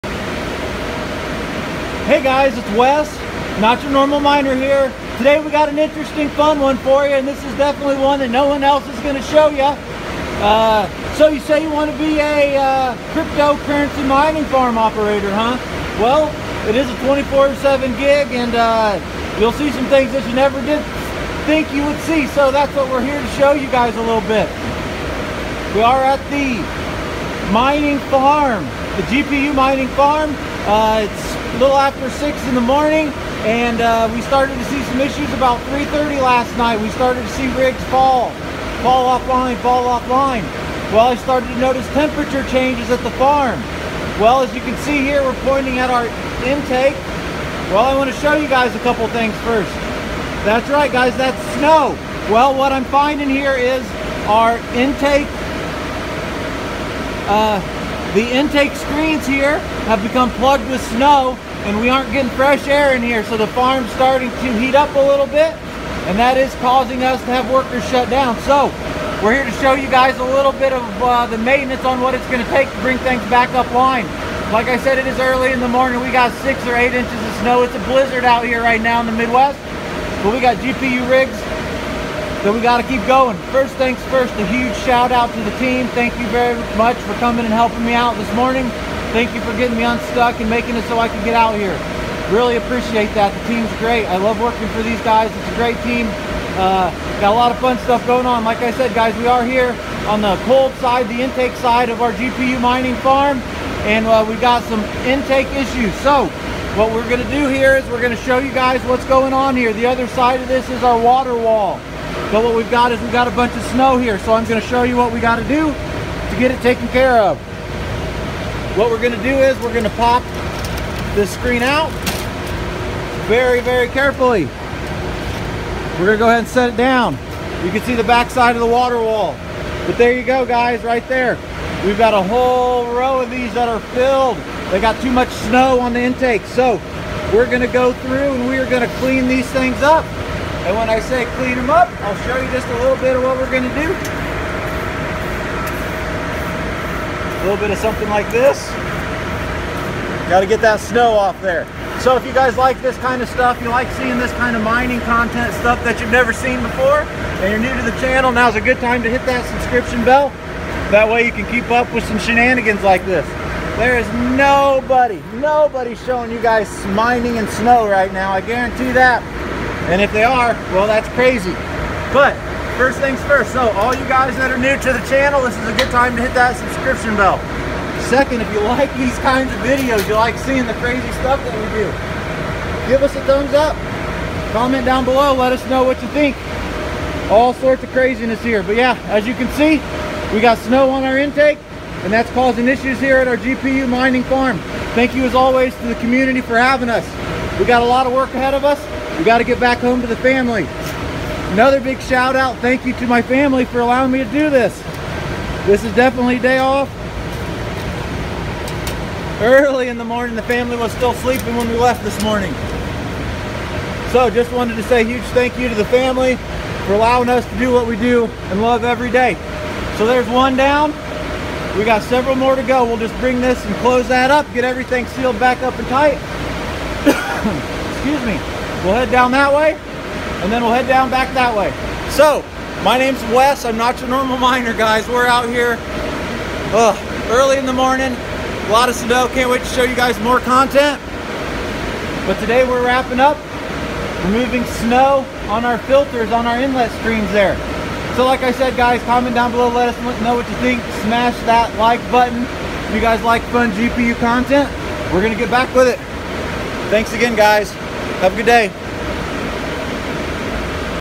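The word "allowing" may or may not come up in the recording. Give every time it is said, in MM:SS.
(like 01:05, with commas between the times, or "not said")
03:23, 03:36.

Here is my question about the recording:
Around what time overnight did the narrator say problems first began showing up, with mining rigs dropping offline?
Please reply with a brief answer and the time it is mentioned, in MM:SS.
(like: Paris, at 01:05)
3:30, at 00:35.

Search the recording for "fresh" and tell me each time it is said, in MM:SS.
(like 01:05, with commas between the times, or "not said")
01:02.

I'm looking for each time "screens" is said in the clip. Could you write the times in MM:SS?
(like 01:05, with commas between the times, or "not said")
00:58, 02:01.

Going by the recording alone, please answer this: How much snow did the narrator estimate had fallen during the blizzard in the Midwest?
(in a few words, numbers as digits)
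6 or 8 inches.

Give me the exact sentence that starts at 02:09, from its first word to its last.
But there you go, guys, right there.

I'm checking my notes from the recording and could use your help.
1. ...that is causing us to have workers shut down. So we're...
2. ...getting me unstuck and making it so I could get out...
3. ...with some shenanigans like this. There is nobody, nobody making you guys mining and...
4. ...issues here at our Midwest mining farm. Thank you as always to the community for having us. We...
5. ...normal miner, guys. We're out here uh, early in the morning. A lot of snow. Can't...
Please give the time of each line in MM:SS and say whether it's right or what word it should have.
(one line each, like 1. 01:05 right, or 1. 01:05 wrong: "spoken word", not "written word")
1. 01:06 right
2. 01:29 right
3. 02:41 wrong: "showing", not "making"
4. 03:12 wrong: "GPU", not "Midwest"
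5. 03:54 right.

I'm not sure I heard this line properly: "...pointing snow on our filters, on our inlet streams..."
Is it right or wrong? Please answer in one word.
wrong.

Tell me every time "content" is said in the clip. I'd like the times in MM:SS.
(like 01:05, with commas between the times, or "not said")
02:35, 04:00, 04:14.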